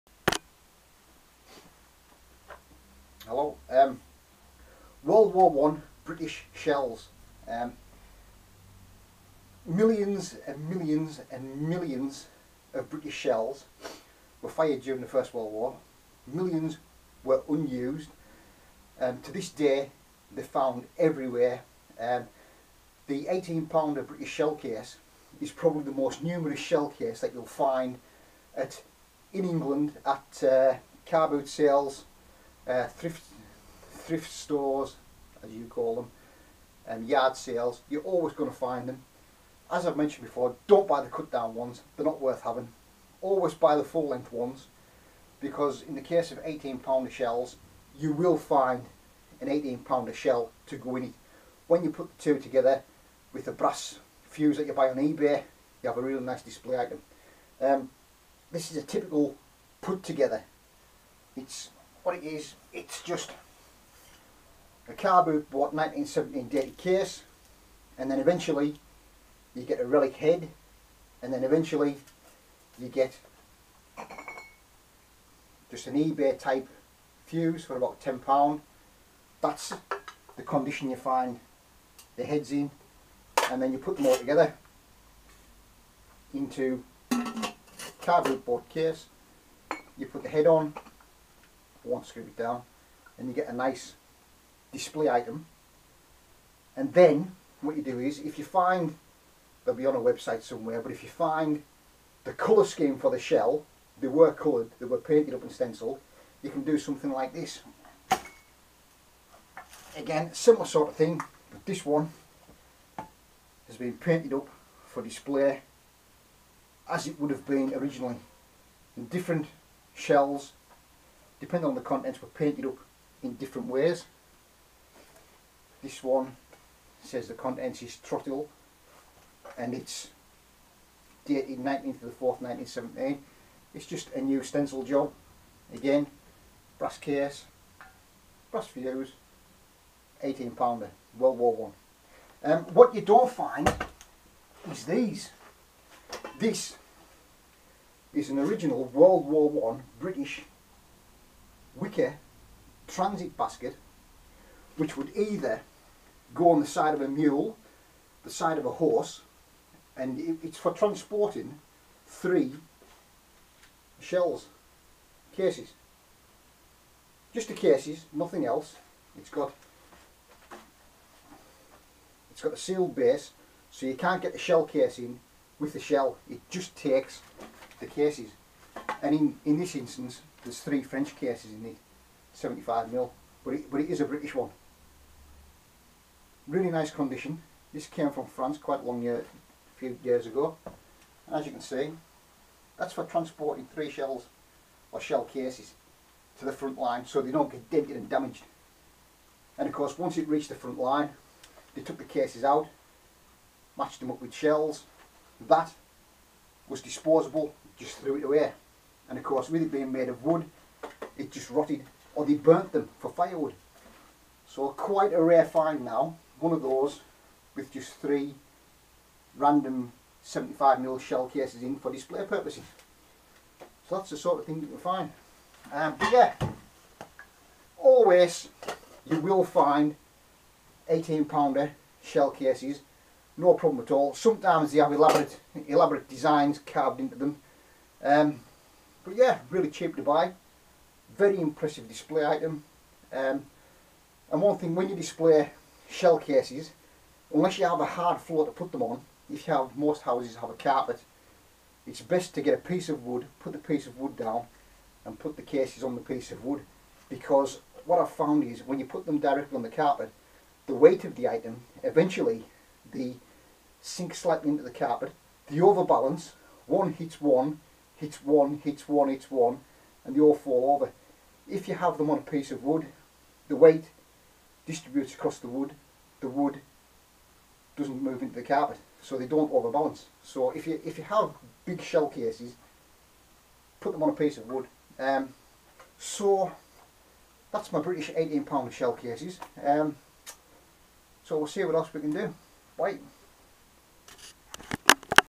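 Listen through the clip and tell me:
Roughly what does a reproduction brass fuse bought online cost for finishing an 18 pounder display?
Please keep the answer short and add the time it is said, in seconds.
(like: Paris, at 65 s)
£10, at 77 s.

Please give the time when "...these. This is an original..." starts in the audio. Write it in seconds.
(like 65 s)
144 s.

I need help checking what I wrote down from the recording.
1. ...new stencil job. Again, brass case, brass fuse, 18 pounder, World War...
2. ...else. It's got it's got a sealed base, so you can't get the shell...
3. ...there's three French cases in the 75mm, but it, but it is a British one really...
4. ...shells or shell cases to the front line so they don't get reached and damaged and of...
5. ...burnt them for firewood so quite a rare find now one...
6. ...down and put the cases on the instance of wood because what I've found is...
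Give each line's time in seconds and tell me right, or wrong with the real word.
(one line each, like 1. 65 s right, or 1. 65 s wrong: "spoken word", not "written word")
1. 134 s right
2. 168 s right
3. 180 s right
4. 193 s wrong: "dented", not "reached"
5. 212 s right
6. 254 s wrong: "piece", not "instance".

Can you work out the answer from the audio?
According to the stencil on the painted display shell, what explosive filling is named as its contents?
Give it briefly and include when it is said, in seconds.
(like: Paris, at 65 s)
Trotyl, at 128 s.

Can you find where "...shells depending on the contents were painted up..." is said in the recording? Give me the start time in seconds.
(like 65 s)
119 s.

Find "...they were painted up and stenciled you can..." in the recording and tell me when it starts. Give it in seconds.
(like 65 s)
104 s.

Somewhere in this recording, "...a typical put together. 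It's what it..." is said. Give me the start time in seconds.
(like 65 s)
58 s.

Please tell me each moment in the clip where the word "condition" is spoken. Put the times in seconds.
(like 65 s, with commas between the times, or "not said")
80 s, 186 s.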